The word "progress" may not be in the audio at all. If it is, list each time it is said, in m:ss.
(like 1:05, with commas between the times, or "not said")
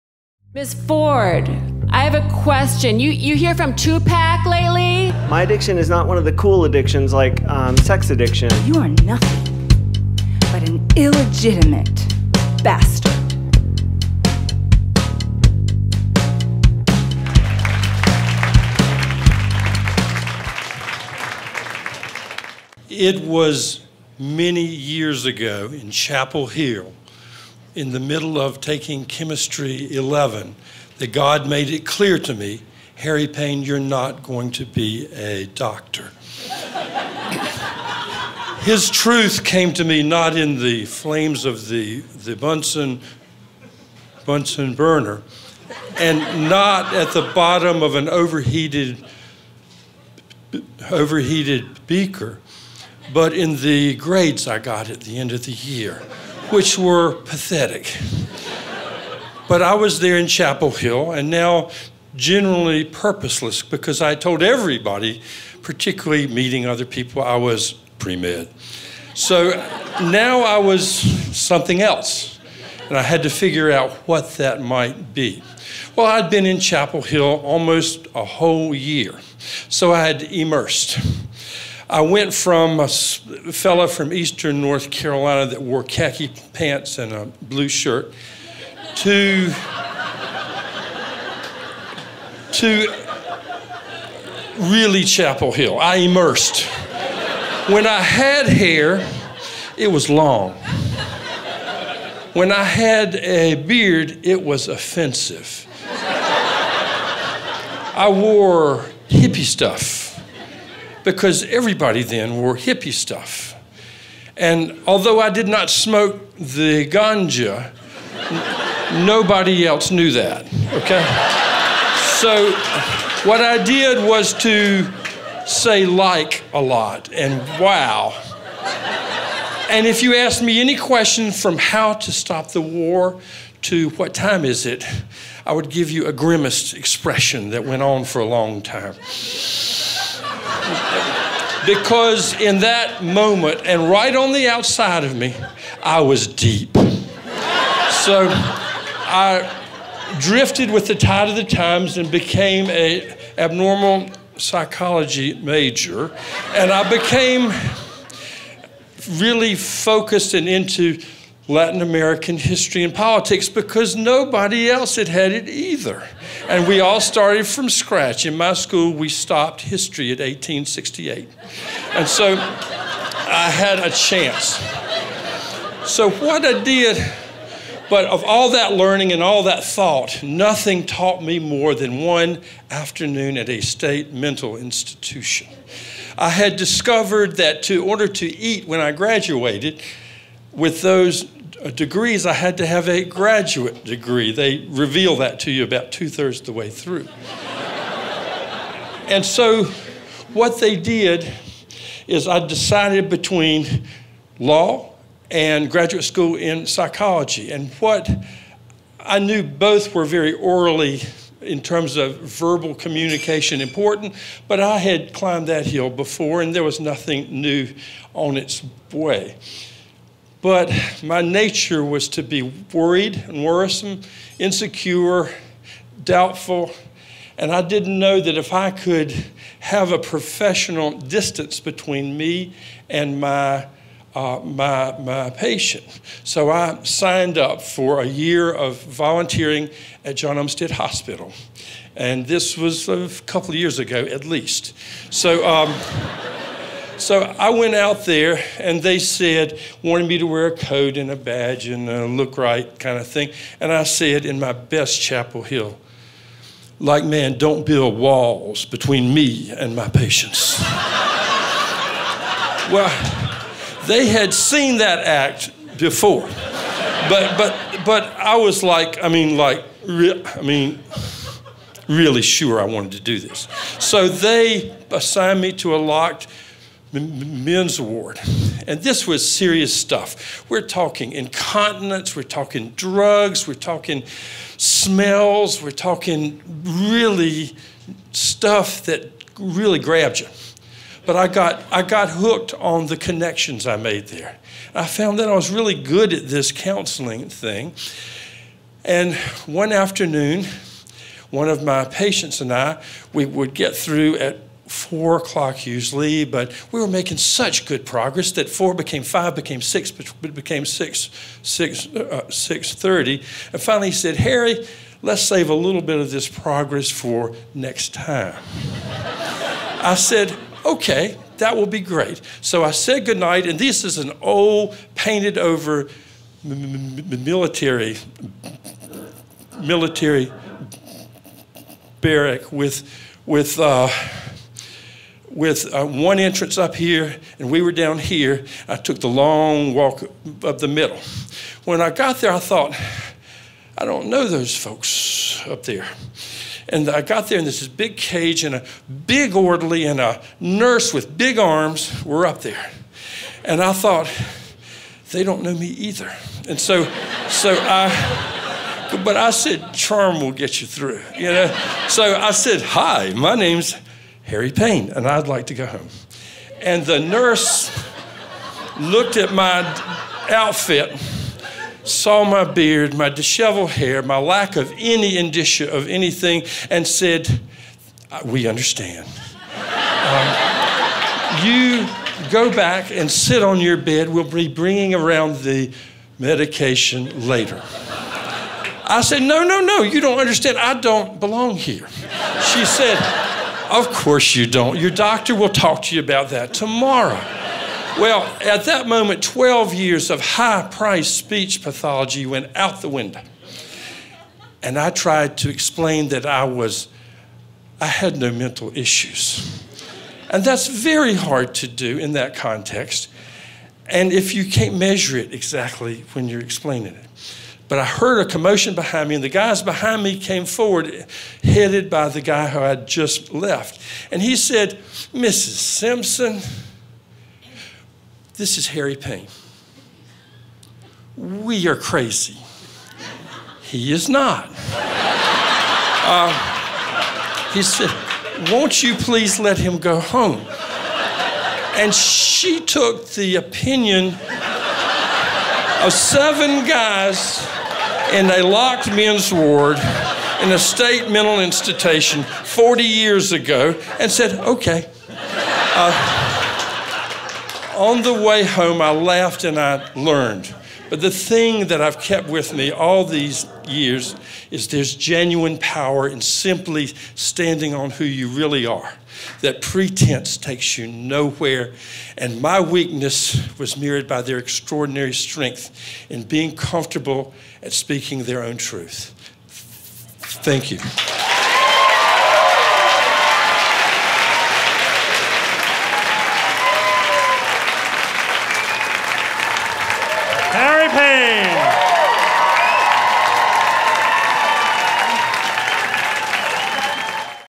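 5:07, 5:16.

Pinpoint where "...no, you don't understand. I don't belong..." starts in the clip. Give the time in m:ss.
6:29.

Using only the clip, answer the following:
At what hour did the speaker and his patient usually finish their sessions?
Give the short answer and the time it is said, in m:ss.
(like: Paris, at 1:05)
four o'clock, at 5:04.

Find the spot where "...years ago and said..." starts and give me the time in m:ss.
7:32.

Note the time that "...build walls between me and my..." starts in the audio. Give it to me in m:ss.
4:17.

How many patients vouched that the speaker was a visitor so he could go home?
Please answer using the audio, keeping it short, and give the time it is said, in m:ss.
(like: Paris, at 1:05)
7, at 7:25.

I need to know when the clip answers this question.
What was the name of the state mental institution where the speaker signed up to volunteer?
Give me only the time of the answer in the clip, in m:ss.
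4:00.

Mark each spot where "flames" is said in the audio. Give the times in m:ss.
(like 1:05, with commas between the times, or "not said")
0:40.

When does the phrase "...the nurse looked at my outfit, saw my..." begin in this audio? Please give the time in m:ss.
6:06.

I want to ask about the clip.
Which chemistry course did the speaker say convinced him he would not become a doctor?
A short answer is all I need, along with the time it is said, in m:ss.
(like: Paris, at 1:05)
Chemistry 11, at 0:29.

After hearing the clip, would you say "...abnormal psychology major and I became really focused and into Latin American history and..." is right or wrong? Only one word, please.
right.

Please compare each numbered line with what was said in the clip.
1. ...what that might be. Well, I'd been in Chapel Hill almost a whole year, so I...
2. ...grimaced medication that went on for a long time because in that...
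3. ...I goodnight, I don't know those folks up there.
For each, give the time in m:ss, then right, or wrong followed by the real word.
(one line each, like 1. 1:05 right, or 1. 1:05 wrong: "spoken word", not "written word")
1. 1:14 right
2. 2:16 wrong: "expression", not "medication"
3. 5:42 wrong: "thought", not "goodnight".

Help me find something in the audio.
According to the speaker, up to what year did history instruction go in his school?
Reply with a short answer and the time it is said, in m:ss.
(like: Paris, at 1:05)
1868, at 2:50.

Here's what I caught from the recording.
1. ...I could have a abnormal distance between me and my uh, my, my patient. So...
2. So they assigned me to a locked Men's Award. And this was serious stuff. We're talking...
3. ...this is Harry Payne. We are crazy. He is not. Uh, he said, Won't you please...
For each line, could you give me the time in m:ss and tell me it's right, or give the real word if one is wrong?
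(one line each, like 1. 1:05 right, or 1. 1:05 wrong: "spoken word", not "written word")
1. 3:48 wrong: "professional", not "abnormal"
2. 4:33 right
3. 7:08 right.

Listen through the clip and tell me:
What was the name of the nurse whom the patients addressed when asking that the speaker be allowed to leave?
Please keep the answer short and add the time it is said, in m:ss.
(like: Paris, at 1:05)
Mrs. Simpson, at 7:05.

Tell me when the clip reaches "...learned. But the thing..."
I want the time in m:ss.
7:39.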